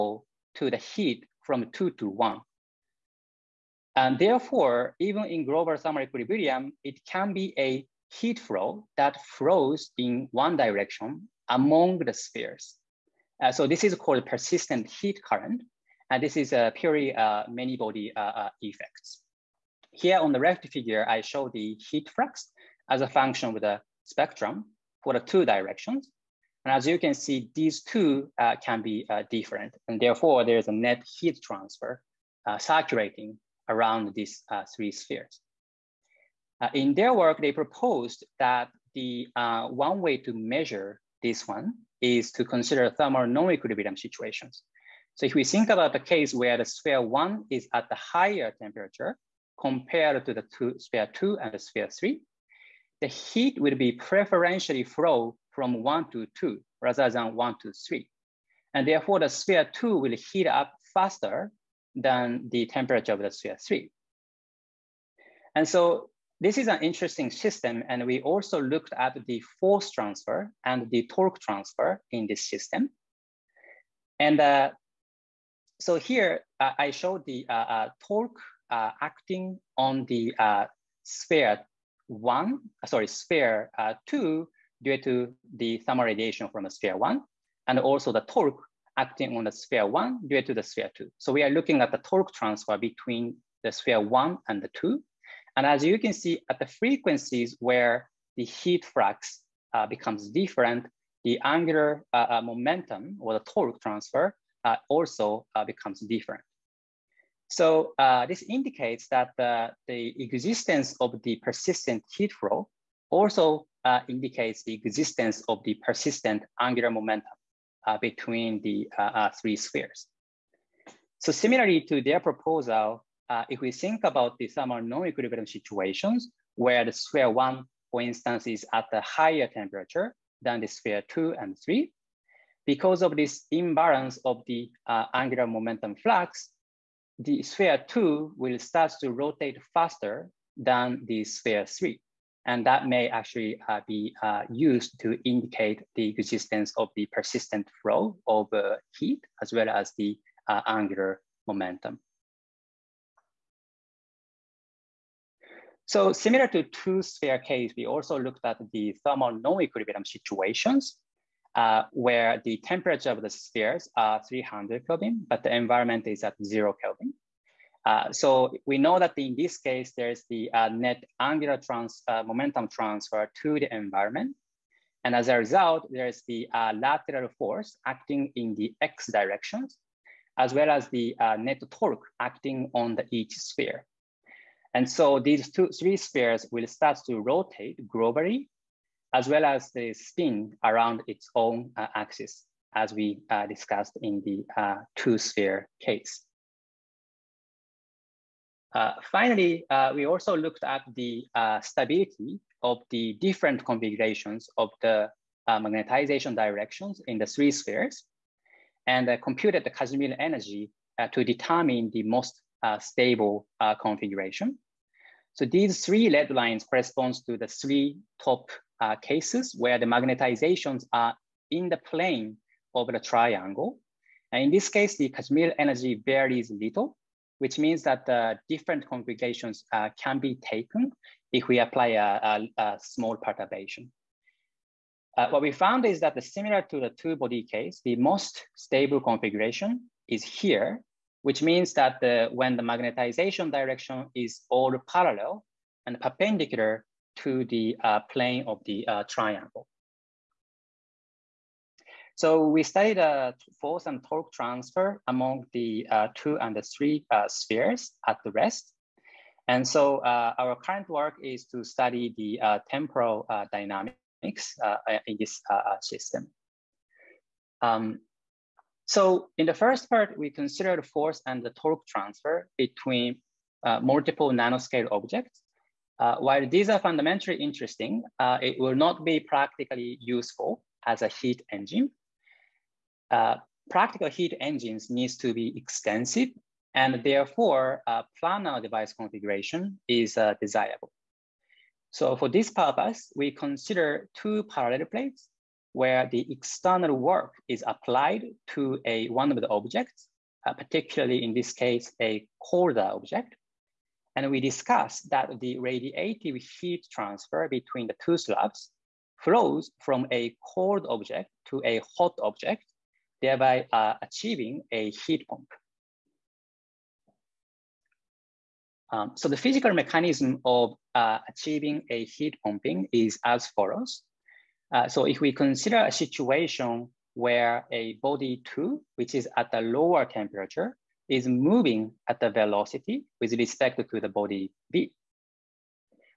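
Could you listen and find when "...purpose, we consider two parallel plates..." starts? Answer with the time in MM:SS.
04:52.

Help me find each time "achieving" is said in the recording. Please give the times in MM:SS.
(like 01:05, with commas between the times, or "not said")
05:14, 05:21.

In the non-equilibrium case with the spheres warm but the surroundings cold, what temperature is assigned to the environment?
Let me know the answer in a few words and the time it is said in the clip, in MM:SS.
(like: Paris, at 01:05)
0 Kelvin, at 02:46.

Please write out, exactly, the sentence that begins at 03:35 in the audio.
So these three red lines corresponds to the three top uh, cases where the magnetizations are in the plane of the triangle.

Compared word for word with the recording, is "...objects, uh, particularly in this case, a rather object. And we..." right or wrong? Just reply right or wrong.
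wrong.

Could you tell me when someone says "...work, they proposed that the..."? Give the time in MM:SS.
00:37.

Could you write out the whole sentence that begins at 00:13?
Uh, so this is called persistent heat current.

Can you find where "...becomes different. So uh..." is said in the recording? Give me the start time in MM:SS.
01:45.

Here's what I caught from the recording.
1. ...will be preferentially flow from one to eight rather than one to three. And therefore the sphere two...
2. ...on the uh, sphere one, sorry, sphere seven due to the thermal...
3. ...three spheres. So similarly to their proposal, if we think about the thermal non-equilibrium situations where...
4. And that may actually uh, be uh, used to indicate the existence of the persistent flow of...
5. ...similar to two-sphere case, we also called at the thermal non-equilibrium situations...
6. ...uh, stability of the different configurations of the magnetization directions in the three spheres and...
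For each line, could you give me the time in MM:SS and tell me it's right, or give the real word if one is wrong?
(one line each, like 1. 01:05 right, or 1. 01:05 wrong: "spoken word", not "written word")
1. 00:53 wrong: "two", not "eight"
2. 01:19 wrong: "two", not "seven"
3. 01:59 right
4. 02:22 right
5. 02:36 wrong: "looked", not "called"
6. 03:21 right.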